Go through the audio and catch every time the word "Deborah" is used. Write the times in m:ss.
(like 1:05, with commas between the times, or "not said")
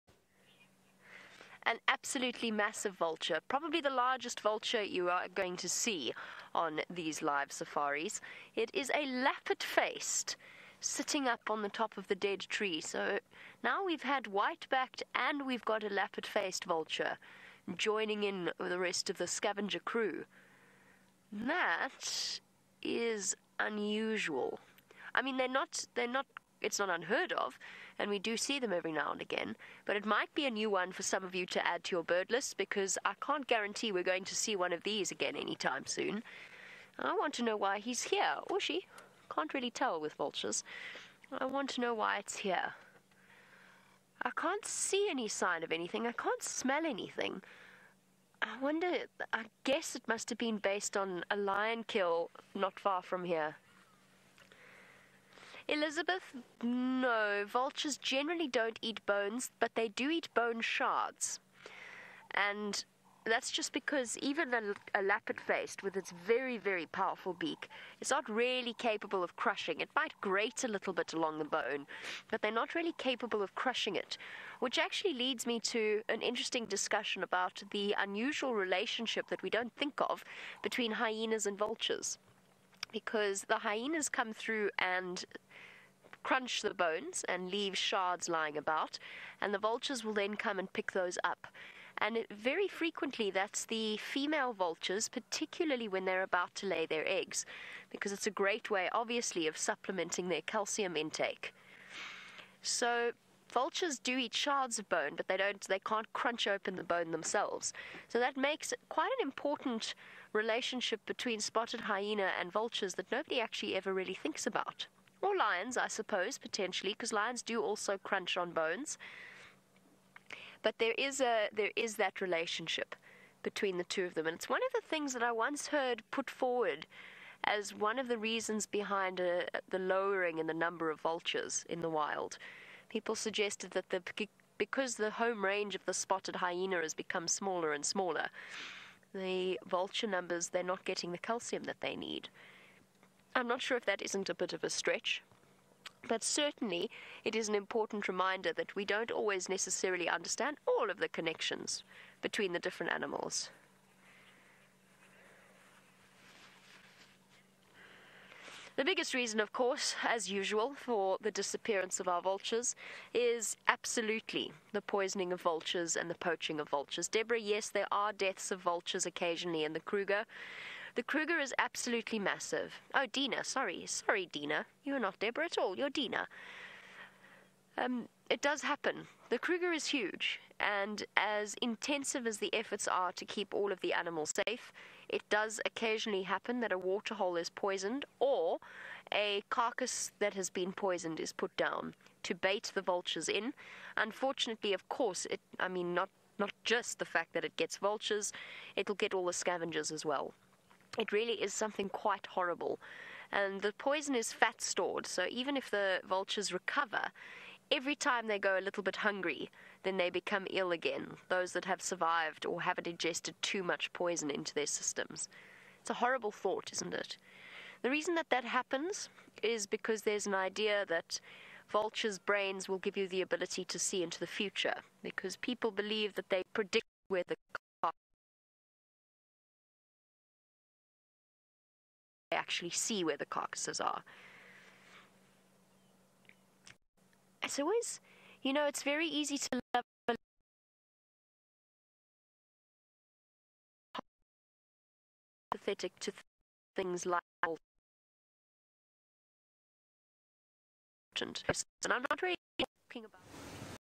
2:47, 2:55.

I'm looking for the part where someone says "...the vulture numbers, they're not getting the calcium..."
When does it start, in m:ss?
2:19.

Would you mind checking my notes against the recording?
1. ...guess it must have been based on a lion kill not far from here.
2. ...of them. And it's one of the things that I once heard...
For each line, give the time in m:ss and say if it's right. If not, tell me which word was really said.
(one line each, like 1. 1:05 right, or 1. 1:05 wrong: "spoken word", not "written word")
1. 0:49 right
2. 2:04 right.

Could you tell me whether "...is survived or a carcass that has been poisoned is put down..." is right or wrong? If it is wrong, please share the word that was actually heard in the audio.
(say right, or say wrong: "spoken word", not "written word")
wrong: "poisoned", not "survived".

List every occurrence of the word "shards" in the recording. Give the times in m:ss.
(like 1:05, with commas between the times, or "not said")
1:00, 1:27, 1:44.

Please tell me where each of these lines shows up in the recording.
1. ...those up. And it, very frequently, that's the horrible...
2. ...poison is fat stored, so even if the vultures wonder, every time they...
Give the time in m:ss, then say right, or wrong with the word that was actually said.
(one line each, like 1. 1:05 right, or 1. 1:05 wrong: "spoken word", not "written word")
1. 1:30 wrong: "female", not "horrible"
2. 3:23 wrong: "recover", not "wonder".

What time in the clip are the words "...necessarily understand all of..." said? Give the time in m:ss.
2:29.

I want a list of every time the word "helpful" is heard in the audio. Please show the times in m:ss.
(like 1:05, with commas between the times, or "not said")
not said.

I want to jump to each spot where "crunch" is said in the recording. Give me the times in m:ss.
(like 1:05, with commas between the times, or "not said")
1:26, 1:46, 1:57.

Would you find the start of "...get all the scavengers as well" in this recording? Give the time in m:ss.
3:18.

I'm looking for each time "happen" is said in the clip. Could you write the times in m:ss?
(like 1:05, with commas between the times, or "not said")
2:58, 3:06, 3:38.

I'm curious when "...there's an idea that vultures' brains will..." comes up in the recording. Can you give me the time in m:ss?
3:40.